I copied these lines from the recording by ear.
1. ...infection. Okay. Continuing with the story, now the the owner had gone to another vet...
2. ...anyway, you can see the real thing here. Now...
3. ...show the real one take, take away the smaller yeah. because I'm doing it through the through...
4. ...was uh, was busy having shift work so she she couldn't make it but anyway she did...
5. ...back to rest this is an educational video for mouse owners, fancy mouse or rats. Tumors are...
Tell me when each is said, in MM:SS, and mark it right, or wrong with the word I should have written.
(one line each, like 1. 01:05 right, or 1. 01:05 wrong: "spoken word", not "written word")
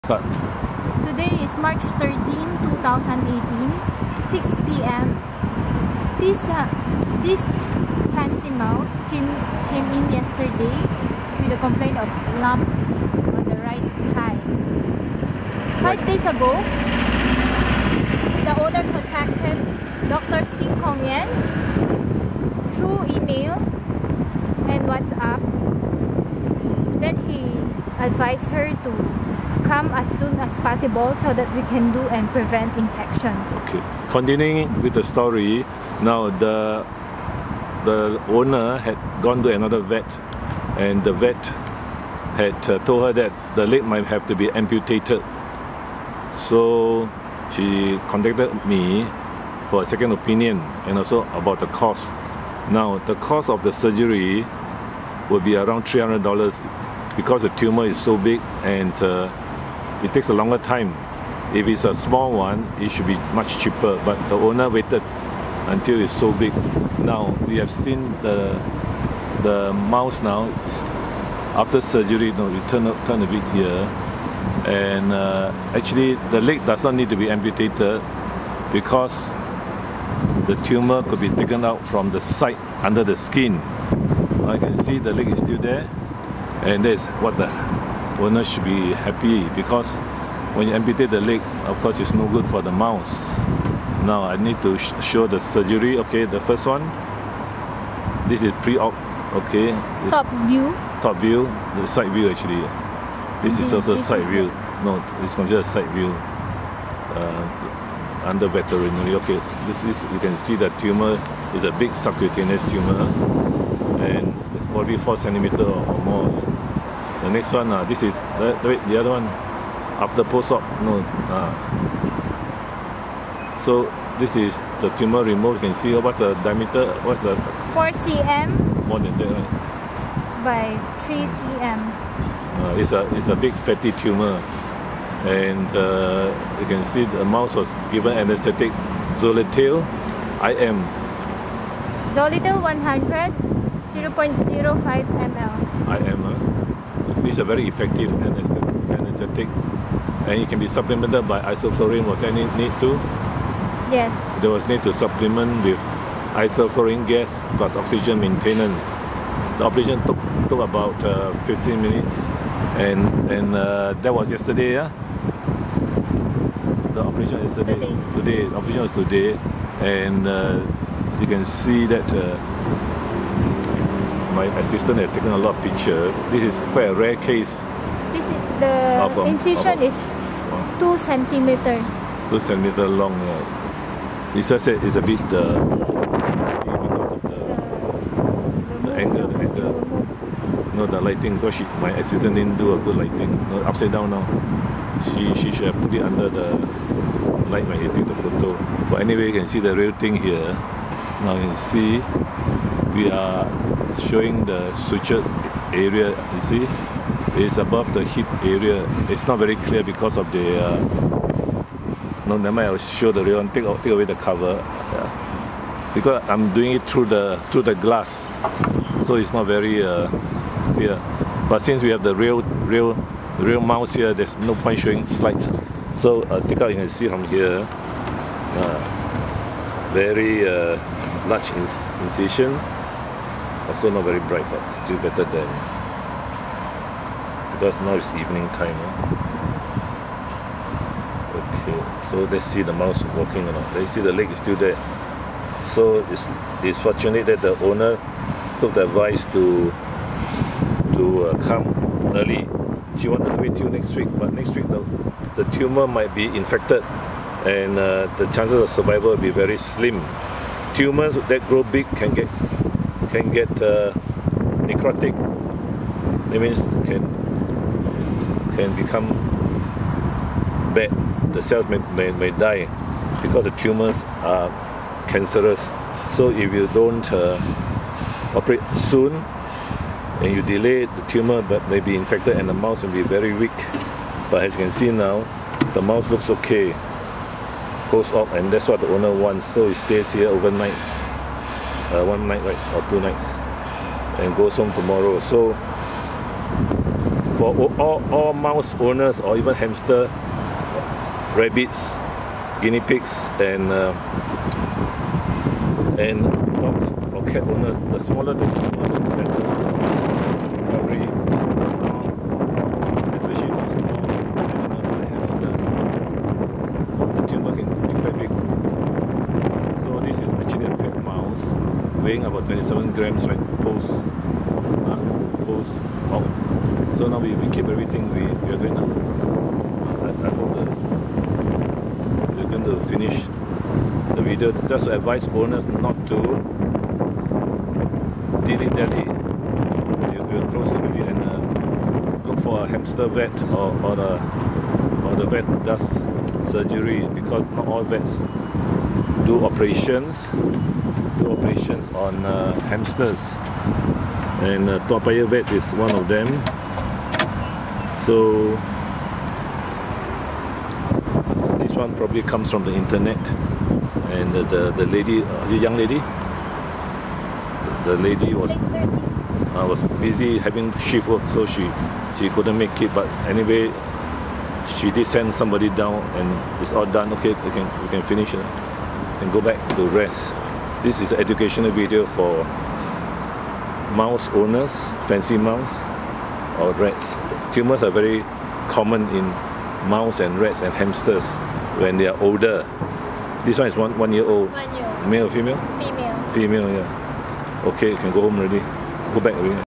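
1. 00:32 right
2. 03:19 right
3. 03:32 wrong: "cover", not "smaller"
4. 06:08 right
5. 06:19 right.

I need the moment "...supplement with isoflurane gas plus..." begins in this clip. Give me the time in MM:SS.
02:34.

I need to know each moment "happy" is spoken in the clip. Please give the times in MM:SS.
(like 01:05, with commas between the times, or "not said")
01:28.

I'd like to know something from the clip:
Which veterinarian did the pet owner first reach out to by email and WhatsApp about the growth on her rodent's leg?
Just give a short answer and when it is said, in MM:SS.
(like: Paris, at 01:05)
Dr. Sing Kong Yen, at 00:20.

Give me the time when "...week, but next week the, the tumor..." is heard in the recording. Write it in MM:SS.
04:13.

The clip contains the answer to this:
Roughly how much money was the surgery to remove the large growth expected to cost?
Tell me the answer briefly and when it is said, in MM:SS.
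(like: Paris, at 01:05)
$300, at 00:55.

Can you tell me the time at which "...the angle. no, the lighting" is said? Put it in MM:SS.
03:09.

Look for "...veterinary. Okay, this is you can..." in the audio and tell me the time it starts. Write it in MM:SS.
01:48.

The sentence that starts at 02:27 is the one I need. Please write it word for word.
It is are very effective anesthetic and it can be supplemented by isoflurane.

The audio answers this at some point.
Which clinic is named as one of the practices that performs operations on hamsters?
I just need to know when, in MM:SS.
05:54.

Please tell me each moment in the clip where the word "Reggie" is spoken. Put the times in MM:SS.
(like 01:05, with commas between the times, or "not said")
not said.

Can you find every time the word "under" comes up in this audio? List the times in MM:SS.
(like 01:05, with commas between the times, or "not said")
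01:22, 01:48, 03:16.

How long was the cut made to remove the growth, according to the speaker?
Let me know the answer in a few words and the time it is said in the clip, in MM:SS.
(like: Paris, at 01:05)
2 centimeters, at 03:02.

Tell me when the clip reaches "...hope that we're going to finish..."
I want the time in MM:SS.
05:30.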